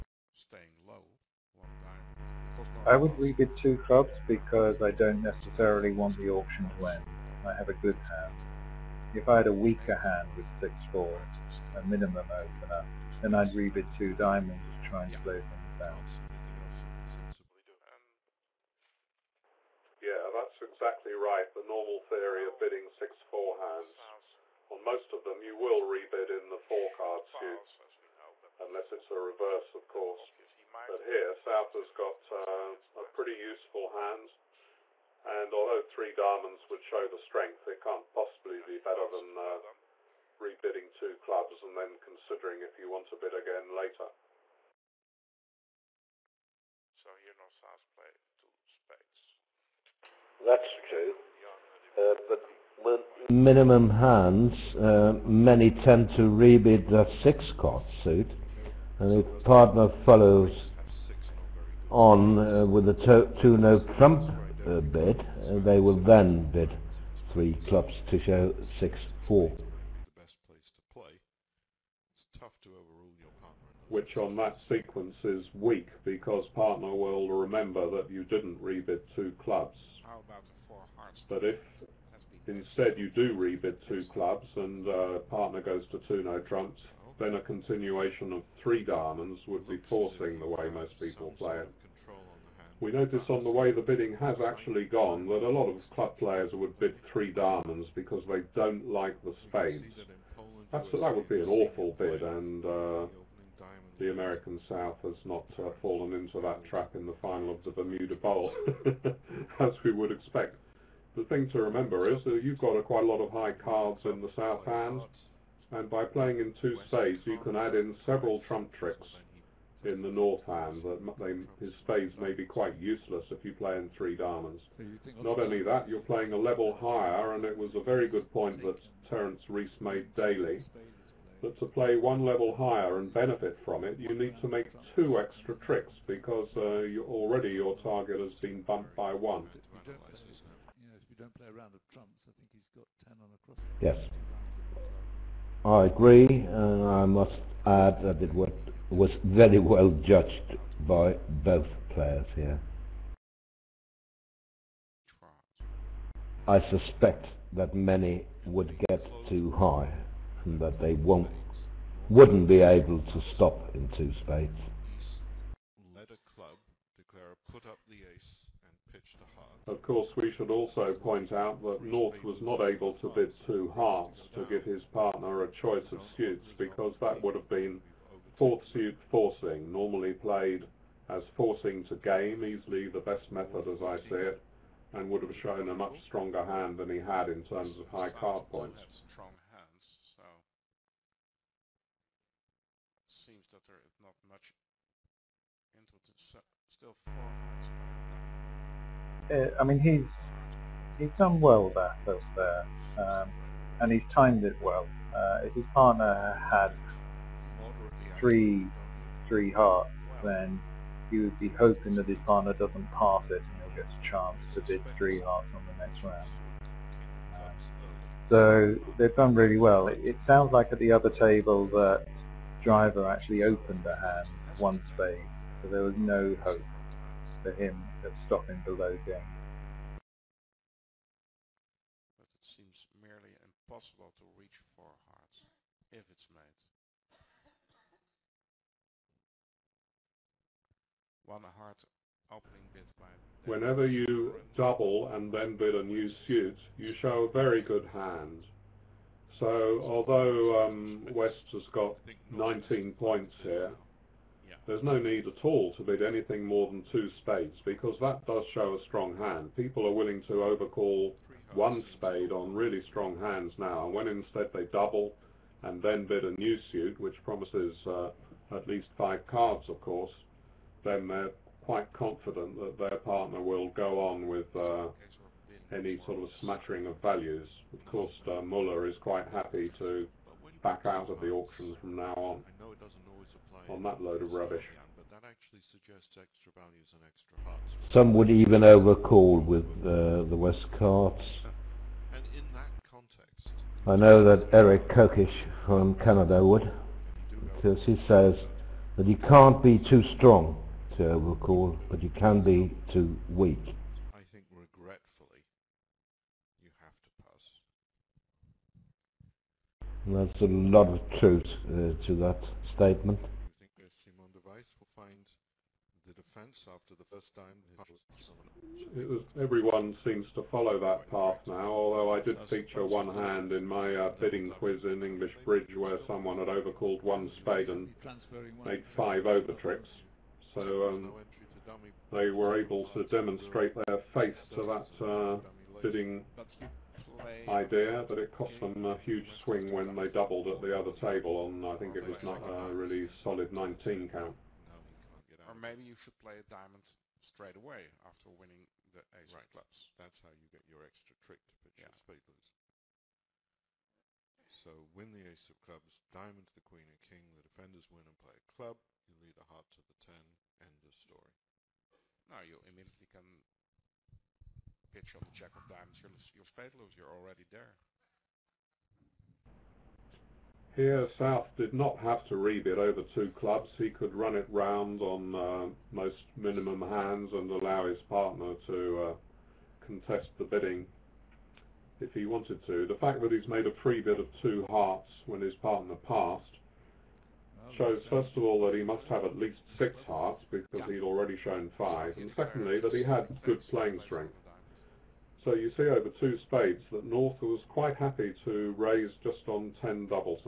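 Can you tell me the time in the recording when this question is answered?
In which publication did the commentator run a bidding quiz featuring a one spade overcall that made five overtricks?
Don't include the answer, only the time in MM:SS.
05:25.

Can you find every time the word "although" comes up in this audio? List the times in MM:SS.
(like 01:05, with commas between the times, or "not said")
00:35, 04:09, 05:21.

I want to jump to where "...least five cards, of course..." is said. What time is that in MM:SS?
04:28.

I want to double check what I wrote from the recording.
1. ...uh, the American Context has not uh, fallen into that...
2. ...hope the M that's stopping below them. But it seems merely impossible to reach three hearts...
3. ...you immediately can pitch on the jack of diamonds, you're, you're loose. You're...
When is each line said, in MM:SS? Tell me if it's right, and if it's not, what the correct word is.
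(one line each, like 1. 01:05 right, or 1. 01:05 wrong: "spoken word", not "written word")
1. 01:42 wrong: "South", not "Context"
2. 03:46 wrong: "four", not "three"
3. 06:02 right.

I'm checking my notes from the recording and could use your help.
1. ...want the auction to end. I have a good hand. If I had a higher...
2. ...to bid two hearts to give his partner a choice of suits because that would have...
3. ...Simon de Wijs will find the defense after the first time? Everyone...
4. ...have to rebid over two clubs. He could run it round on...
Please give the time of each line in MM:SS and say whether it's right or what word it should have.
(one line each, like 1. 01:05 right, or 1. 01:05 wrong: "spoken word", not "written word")
1. 00:05 wrong: "weaker", not "higher"
2. 02:52 right
3. 05:14 right
4. 06:11 right.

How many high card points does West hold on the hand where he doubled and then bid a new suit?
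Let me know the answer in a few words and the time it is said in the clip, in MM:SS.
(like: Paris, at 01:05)
19, at 04:12.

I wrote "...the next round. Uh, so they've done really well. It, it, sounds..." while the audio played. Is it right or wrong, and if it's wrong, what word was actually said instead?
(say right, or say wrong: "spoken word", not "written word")
right.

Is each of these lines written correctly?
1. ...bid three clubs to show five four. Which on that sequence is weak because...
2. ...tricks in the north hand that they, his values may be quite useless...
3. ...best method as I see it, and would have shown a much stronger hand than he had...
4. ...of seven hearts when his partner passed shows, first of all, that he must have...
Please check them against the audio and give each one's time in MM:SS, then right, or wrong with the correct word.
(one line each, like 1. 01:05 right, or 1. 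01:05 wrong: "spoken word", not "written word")
1. 01:06 wrong: "six", not "five"
2. 01:58 wrong: "spades", not "values"
3. 03:02 right
4. 06:24 wrong: "two", not "seven".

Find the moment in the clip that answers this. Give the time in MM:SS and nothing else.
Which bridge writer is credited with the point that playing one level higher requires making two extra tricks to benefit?
02:09.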